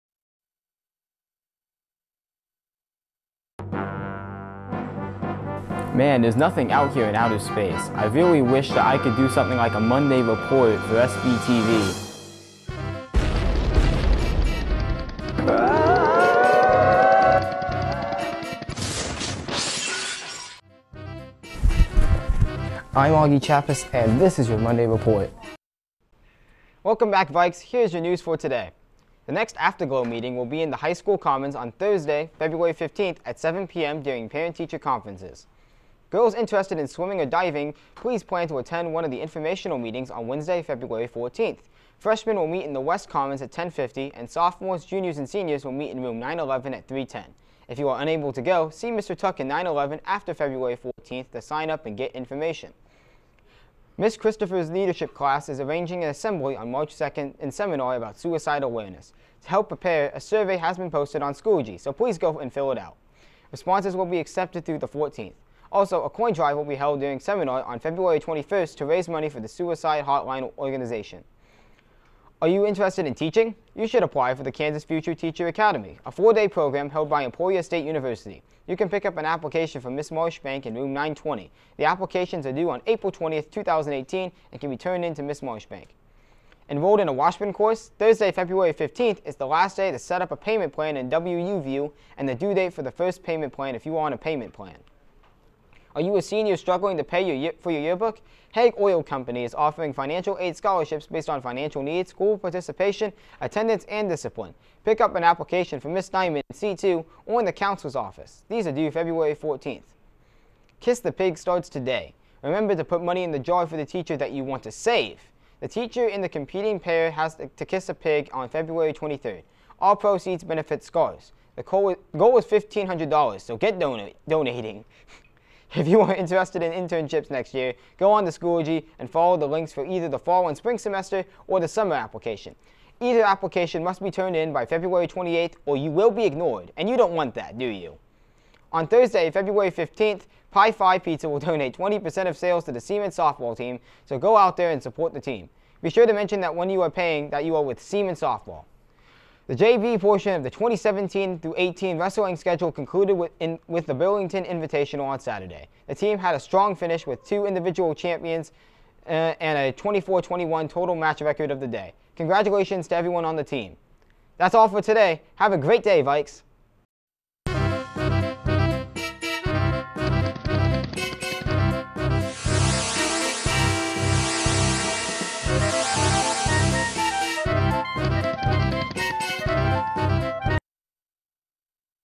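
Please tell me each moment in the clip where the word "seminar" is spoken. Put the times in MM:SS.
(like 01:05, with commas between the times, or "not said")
00:57, 01:07.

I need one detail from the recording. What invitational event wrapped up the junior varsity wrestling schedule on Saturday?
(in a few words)
Burlington Invitational.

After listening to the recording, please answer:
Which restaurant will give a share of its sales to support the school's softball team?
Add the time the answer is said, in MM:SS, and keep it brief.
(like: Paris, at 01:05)
Pie Five Pizza, at 02:20.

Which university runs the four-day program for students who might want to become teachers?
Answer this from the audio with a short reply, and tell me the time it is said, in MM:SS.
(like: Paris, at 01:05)
Emporia State University, at 01:17.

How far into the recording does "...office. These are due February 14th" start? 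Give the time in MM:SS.
01:47.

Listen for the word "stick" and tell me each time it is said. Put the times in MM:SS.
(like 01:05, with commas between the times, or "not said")
not said.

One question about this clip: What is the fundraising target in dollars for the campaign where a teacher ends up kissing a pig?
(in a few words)
$1,500.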